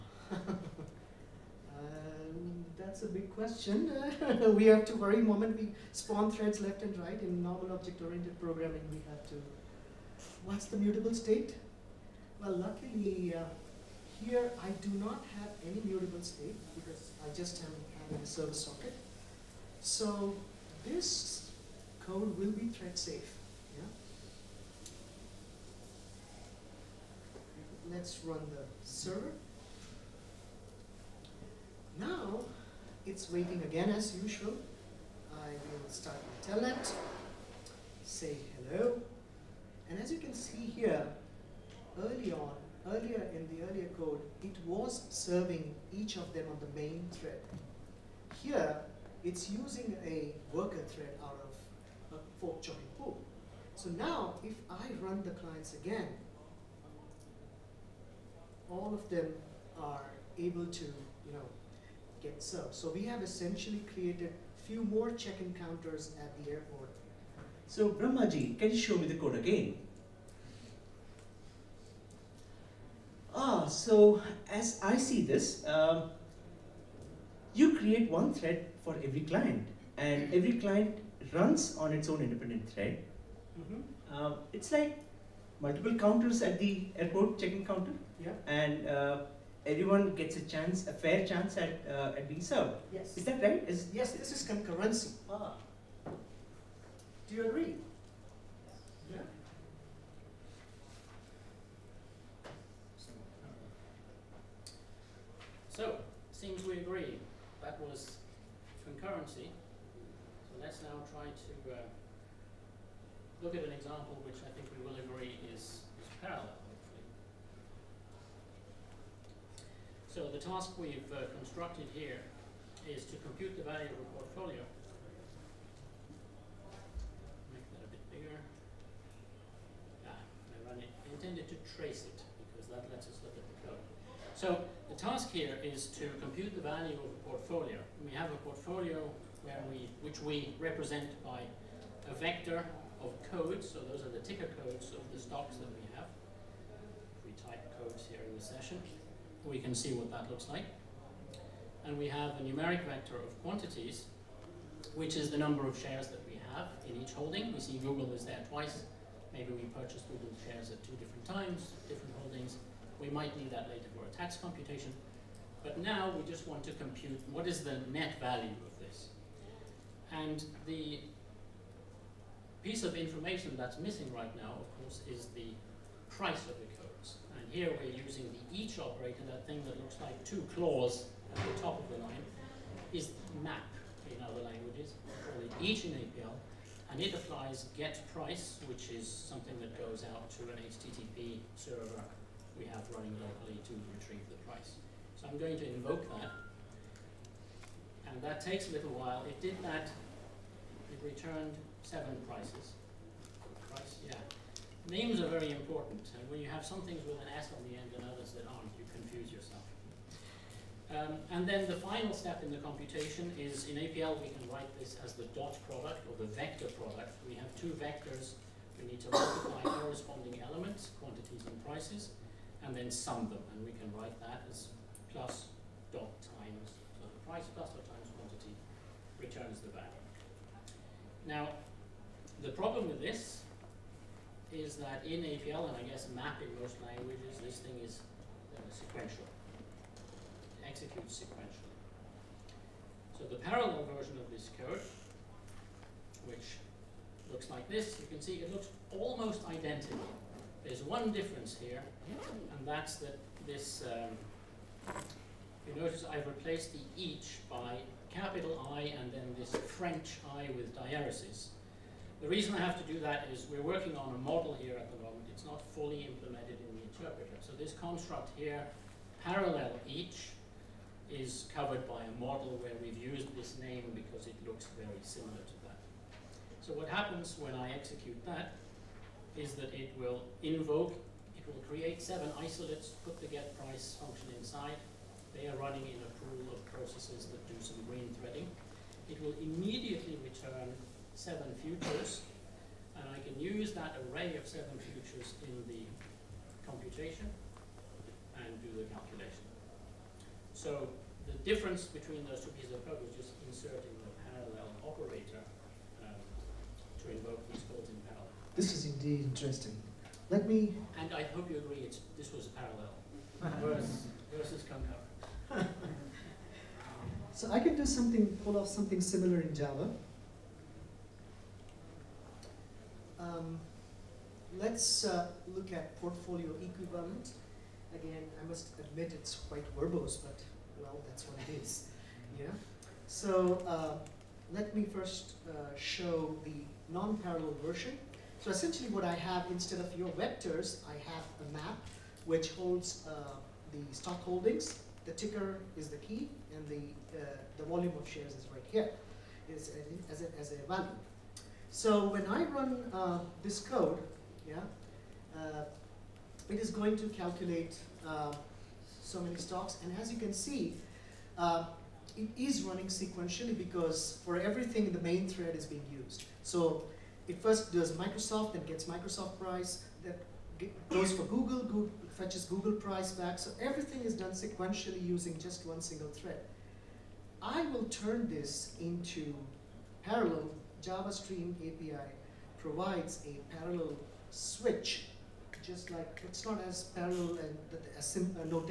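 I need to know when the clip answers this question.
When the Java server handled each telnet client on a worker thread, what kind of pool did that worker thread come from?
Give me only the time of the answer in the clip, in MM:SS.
00:52.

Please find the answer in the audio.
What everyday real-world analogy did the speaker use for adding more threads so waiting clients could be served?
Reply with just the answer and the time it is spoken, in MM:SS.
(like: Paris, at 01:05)
check-in counters, at 01:05.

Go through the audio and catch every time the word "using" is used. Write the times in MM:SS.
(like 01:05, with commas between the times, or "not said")
00:49, 02:58, 06:15.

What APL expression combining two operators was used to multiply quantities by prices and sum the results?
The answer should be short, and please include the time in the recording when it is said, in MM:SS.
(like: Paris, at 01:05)
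plus dot times, at 03:45.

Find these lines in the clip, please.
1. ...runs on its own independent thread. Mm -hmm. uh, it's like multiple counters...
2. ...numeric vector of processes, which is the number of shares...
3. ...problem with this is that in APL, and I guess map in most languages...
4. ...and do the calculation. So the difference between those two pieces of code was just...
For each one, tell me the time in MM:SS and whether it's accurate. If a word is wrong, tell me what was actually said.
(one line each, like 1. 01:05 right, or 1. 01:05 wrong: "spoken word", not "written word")
1. 01:21 right
2. 02:32 wrong: "quantities", not "processes"
3. 03:52 right
4. 04:58 right.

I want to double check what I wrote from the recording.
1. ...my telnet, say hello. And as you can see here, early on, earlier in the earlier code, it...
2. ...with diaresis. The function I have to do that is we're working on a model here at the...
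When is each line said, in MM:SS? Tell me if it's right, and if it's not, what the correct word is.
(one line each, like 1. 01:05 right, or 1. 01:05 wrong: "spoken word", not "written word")
1. 00:36 right
2. 04:20 wrong: "reason", not "function".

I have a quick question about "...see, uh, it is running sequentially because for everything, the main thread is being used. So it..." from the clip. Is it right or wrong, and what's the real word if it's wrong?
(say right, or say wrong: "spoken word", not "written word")
right.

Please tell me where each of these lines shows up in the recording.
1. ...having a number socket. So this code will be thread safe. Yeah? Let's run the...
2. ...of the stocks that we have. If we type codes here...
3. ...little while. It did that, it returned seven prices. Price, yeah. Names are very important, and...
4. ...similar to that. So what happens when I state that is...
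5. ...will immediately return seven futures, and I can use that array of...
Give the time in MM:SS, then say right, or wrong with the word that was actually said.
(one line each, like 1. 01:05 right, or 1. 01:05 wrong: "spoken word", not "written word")
1. 00:18 wrong: "server", not "number"
2. 02:24 right
3. 03:18 right
4. 04:35 wrong: "execute", not "state"
5. 04:49 right.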